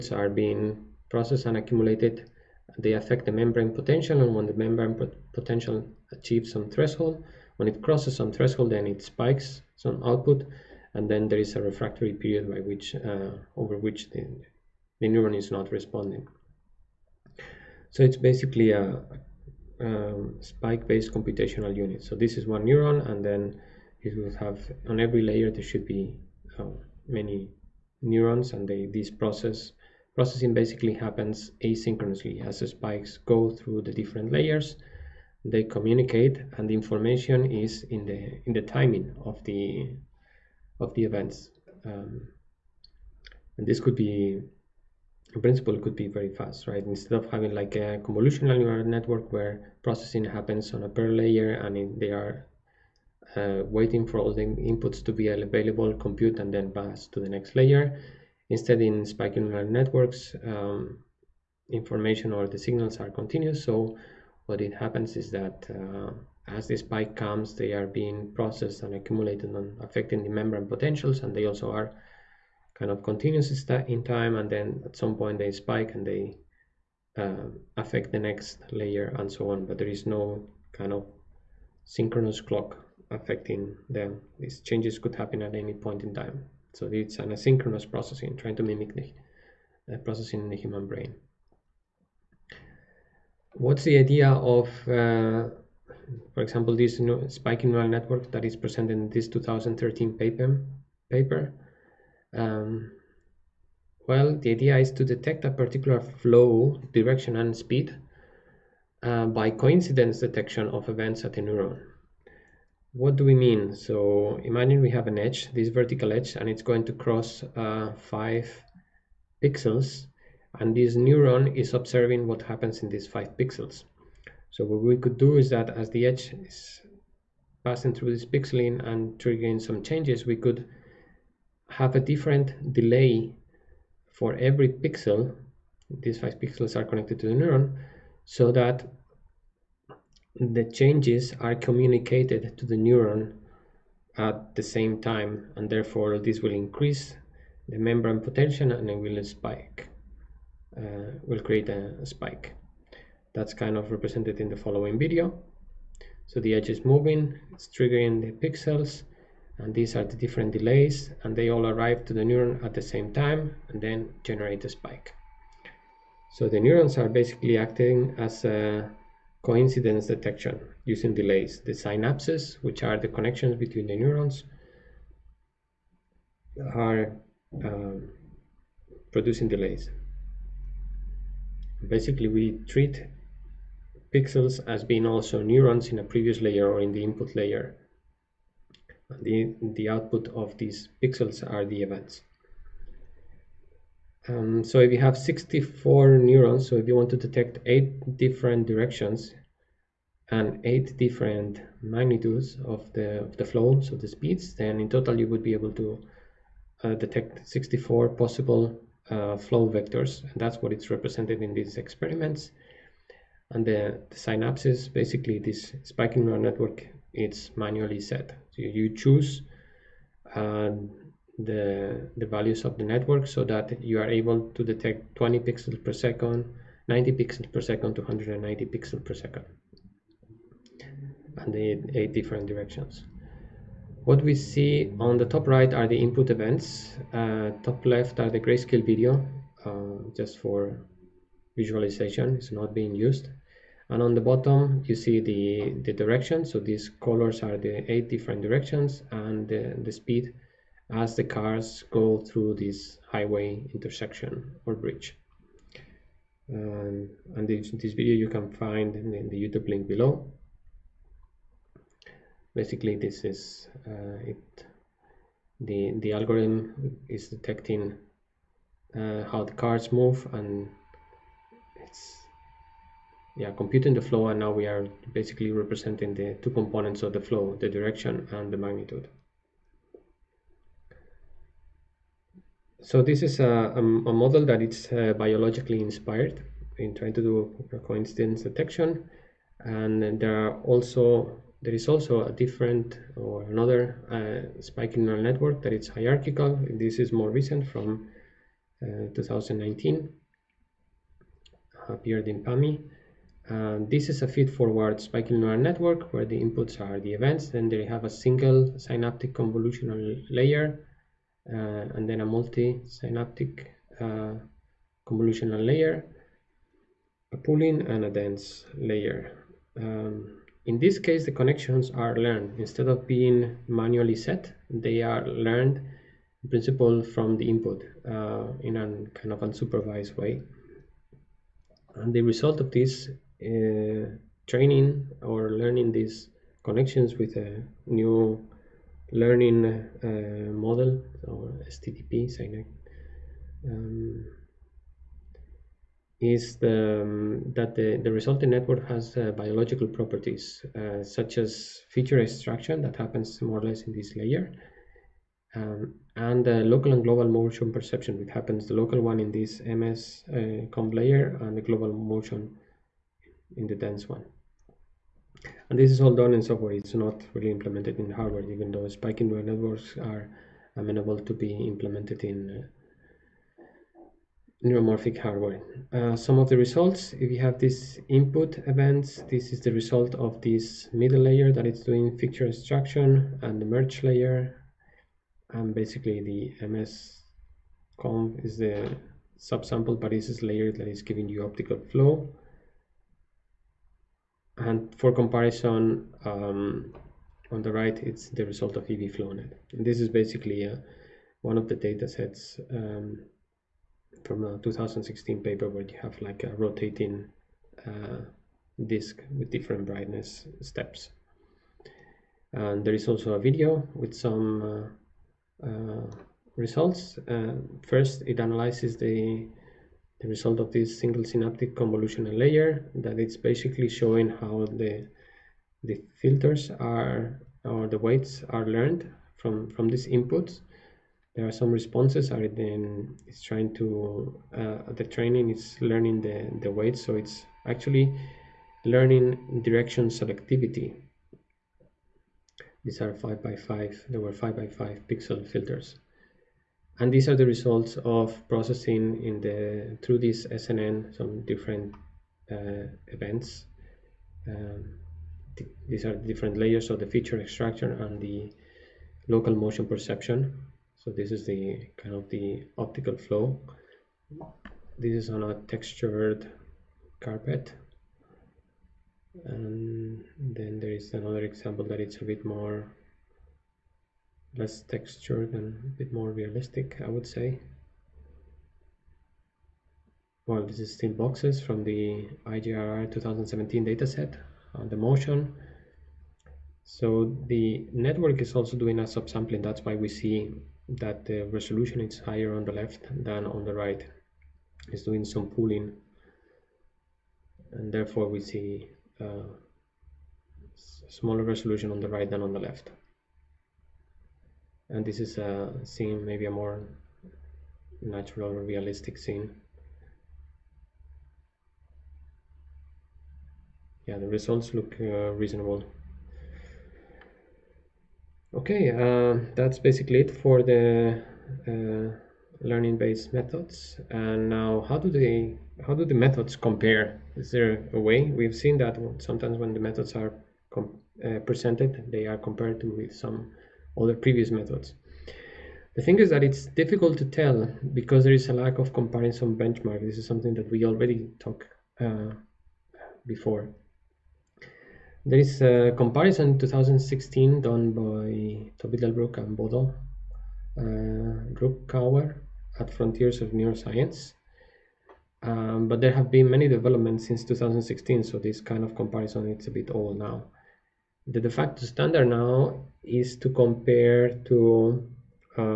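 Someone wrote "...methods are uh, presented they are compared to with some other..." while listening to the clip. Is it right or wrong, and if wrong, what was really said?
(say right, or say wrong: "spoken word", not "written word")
right.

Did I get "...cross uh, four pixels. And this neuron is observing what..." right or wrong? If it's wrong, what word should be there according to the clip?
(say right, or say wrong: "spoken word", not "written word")
wrong: "five", not "four".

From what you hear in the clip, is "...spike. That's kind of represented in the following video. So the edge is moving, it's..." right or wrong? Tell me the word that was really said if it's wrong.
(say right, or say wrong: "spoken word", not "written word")
right.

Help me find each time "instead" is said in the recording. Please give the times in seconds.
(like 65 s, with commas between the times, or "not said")
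46 s, 58 s, 322 s.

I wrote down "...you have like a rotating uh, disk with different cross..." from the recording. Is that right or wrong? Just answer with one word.
wrong.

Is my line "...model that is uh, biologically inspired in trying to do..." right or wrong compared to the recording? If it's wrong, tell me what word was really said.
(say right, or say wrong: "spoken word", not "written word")
right.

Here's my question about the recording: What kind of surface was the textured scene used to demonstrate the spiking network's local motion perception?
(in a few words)
textured carpet.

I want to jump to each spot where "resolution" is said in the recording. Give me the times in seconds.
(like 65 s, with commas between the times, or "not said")
491 s, 501 s.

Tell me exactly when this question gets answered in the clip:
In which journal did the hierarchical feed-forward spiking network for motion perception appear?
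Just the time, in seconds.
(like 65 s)
302 s.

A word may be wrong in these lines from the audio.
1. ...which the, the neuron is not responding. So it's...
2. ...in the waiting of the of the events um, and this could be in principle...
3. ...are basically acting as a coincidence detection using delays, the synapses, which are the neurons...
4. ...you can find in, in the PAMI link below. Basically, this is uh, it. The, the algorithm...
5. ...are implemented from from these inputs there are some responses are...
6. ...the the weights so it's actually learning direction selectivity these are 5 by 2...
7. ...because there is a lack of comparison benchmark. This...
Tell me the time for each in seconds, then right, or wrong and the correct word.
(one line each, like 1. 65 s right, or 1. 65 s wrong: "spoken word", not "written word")
1. 13 s right
2. 38 s wrong: "timing", not "waiting"
3. 166 s wrong: "connections", not "neurons"
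4. 258 s wrong: "YouTube", not "PAMI"
5. 428 s wrong: "learned", not "implemented"
6. 436 s wrong: "5", not "2"
7. 537 s right.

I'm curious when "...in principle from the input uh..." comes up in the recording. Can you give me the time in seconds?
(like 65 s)
326 s.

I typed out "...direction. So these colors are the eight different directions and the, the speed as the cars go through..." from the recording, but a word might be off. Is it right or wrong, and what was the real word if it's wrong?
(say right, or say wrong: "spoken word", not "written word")
right.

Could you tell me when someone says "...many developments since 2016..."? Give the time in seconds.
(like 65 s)
556 s.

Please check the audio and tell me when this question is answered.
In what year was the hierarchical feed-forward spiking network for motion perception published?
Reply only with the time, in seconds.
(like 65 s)
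299 s.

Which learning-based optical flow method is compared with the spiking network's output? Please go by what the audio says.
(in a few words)
EVFlowNet.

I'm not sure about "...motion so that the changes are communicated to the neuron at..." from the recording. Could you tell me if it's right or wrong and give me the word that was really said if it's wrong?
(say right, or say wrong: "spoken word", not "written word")
wrong: "neuron", not "motion".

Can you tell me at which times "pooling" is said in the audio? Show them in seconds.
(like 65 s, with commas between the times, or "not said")
317 s, 495 s.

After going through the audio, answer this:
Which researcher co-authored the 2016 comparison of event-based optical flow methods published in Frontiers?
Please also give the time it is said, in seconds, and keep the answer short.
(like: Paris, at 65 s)
Tobi Delbruck, at 548 s.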